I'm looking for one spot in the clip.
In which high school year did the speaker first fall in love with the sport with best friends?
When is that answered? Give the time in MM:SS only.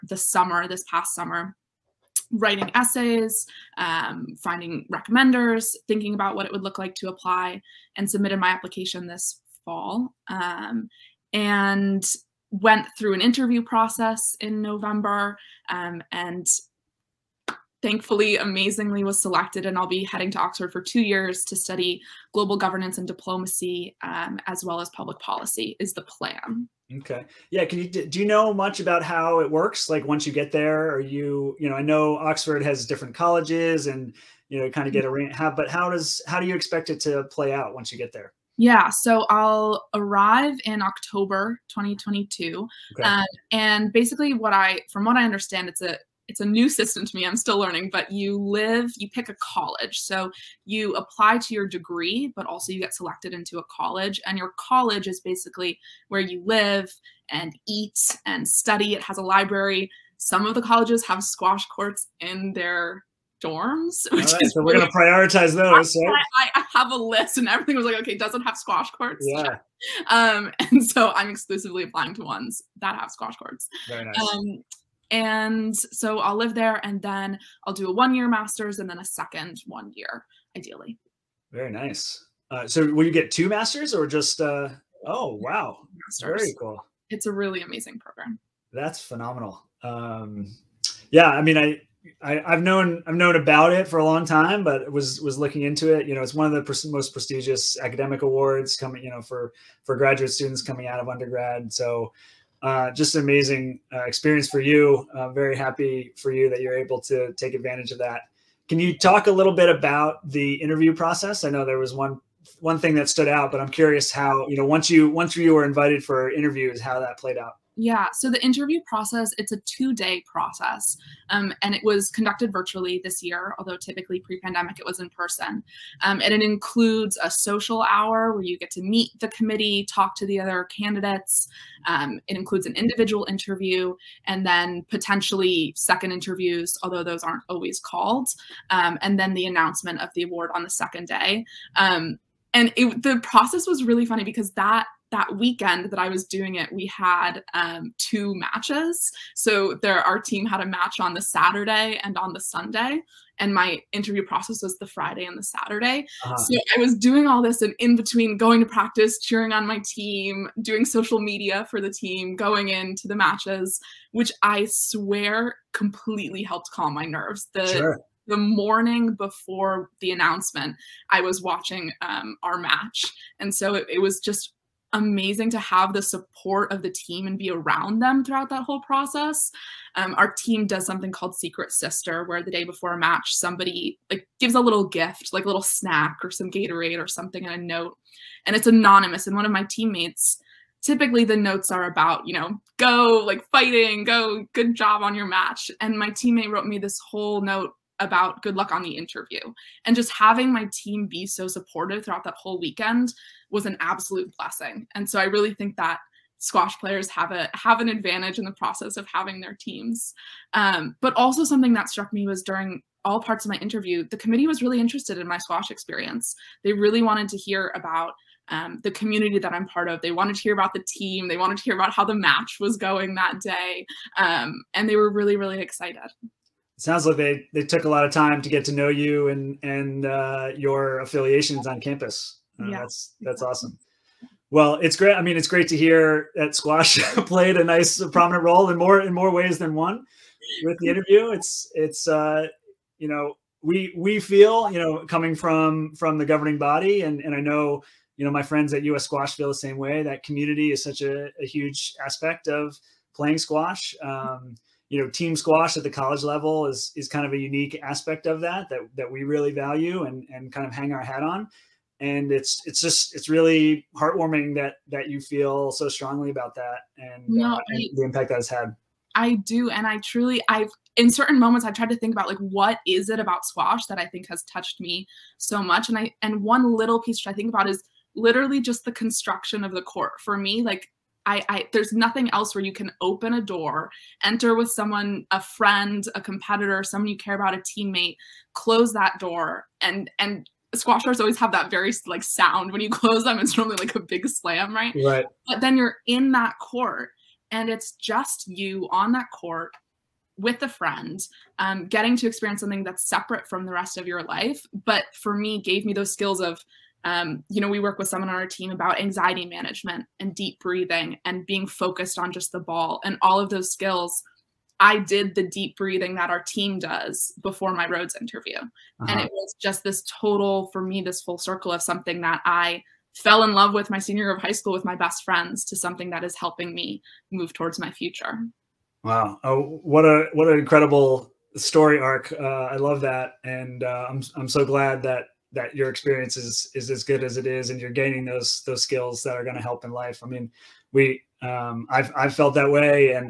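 05:23.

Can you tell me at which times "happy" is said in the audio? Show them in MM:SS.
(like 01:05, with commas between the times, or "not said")
01:45.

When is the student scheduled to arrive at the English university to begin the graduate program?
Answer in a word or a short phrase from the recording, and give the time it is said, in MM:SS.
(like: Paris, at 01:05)
October 2022, at 00:40.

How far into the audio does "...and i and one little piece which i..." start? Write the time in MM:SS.
04:35.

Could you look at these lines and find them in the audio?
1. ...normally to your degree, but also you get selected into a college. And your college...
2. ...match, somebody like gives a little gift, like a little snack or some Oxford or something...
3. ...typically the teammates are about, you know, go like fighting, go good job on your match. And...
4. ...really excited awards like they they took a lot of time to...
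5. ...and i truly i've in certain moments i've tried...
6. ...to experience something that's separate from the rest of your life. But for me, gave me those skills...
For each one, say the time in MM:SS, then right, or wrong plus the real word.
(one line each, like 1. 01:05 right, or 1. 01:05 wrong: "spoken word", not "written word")
1. 00:50 wrong: "apply", not "normally"
2. 03:02 wrong: "Gatorade", not "Oxford"
3. 03:10 wrong: "notes", not "teammates"
4. 03:45 wrong: "sounds", not "awards"
5. 04:29 right
6. 05:02 right.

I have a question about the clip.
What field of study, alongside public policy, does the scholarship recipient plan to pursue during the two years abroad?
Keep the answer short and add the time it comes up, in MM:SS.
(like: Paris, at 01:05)
Global governance and diplomacy, at 00:22.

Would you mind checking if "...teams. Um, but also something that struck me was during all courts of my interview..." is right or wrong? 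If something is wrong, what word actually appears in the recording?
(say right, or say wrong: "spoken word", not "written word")
wrong: "parts", not "courts".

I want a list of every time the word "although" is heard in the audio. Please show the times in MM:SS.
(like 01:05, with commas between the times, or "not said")
02:03, 02:16.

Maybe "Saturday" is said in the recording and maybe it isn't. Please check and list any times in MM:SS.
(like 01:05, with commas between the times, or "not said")
02:31, 02:35.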